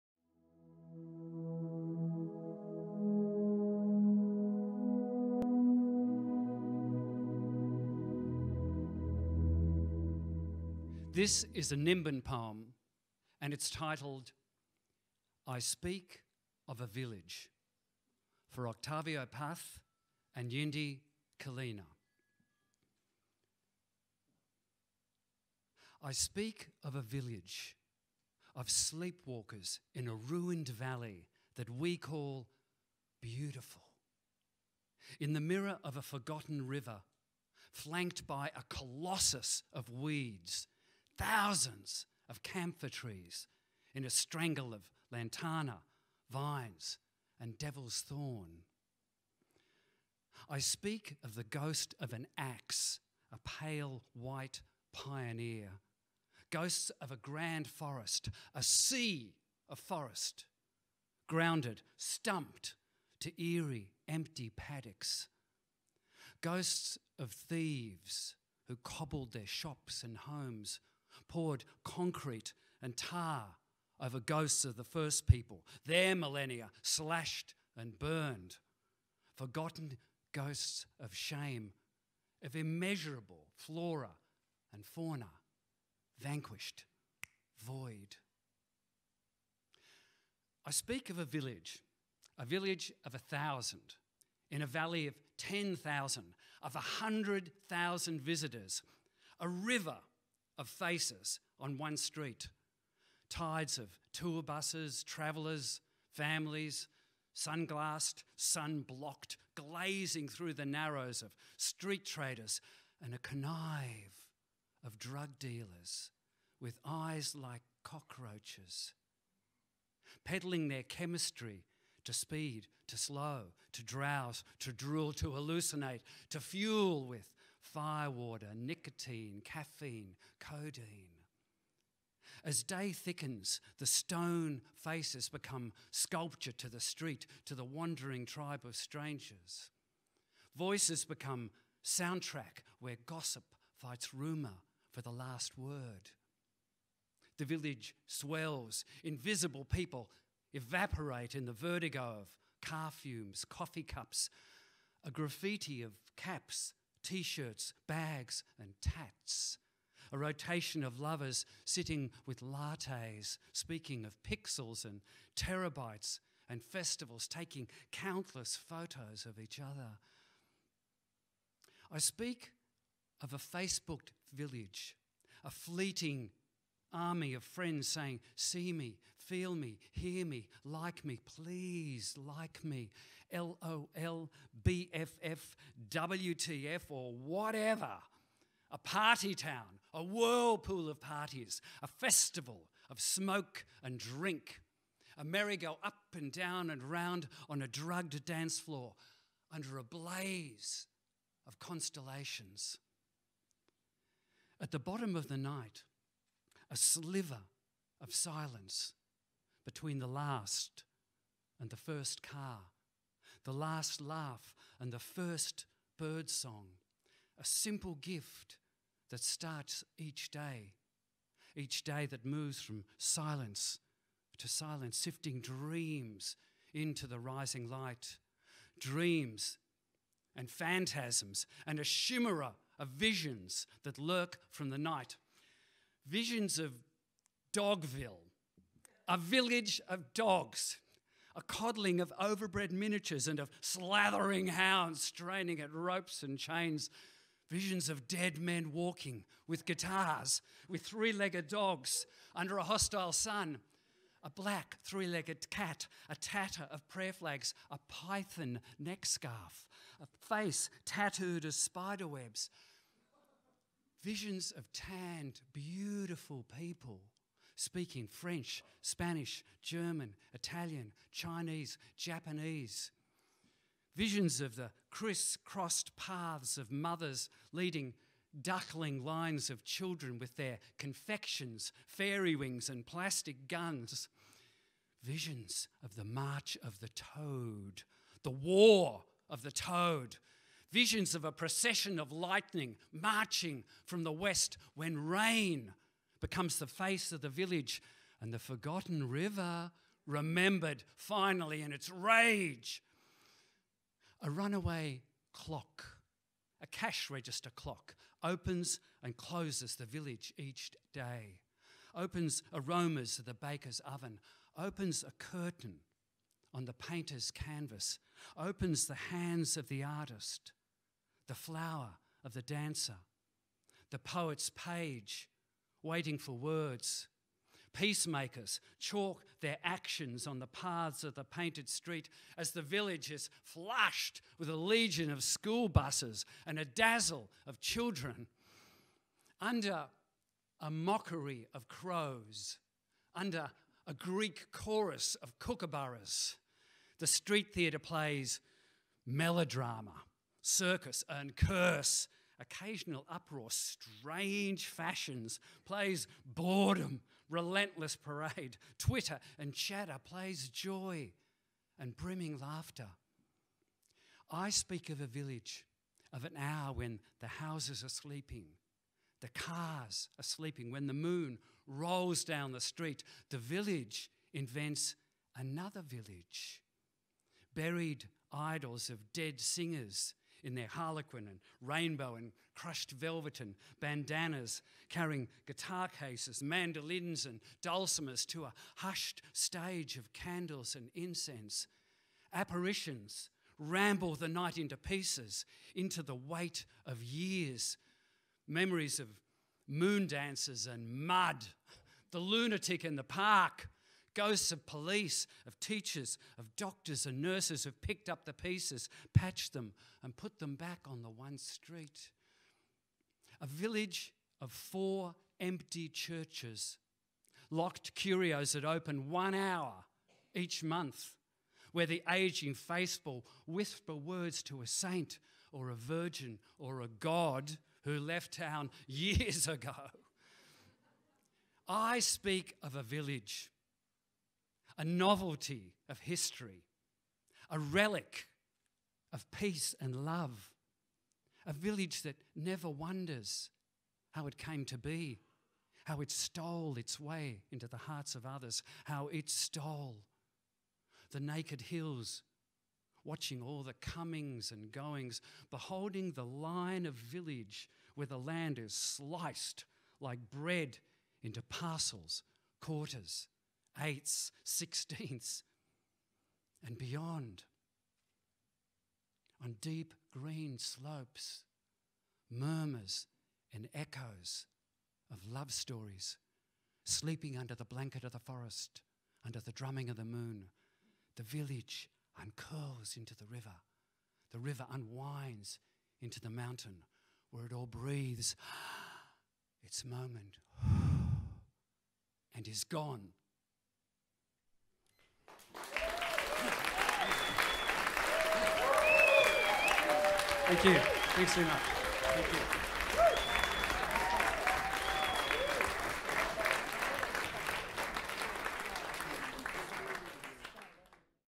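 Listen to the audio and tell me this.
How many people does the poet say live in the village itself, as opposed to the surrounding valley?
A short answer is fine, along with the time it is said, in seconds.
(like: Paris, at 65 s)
1000, at 93 s.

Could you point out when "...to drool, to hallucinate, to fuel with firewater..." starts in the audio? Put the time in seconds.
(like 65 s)
124 s.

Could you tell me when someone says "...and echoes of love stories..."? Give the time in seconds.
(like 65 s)
473 s.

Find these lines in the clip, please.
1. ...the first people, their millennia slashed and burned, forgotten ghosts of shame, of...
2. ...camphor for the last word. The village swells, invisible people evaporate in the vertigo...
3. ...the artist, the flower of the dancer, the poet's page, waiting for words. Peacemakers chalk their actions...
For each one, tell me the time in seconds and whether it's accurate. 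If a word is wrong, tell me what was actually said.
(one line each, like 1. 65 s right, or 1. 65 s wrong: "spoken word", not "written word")
1. 74 s right
2. 144 s wrong: "rumor", not "camphor"
3. 319 s right.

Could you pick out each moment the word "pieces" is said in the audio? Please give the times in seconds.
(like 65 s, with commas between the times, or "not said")
394 s, 408 s.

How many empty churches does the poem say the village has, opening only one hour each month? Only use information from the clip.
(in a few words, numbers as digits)
4.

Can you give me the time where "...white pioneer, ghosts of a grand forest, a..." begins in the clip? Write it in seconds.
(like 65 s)
54 s.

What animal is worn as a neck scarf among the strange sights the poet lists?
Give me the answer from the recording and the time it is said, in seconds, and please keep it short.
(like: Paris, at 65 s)
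python, at 257 s.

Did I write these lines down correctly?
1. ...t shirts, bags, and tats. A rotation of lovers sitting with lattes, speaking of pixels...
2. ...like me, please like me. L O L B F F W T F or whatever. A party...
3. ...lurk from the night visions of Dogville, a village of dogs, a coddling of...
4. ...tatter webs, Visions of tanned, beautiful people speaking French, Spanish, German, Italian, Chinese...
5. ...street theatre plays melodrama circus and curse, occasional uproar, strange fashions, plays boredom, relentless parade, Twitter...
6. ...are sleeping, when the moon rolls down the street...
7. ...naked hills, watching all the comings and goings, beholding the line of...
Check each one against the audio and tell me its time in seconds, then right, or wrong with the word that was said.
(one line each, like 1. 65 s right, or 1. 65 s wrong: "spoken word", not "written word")
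1. 157 s right
2. 180 s right
3. 233 s right
4. 261 s wrong: "spider", not "tatter"
5. 347 s right
6. 370 s right
7. 451 s right.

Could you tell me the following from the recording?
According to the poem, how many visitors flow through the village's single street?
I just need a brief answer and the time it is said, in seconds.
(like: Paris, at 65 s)
100,000, at 96 s.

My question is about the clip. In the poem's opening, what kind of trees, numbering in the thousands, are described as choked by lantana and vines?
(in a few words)
camphor.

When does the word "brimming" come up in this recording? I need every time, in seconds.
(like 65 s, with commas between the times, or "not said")
361 s.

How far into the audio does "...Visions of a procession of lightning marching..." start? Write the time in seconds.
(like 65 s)
290 s.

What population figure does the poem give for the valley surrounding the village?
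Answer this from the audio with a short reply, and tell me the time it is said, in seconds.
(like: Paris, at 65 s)
10,000, at 95 s.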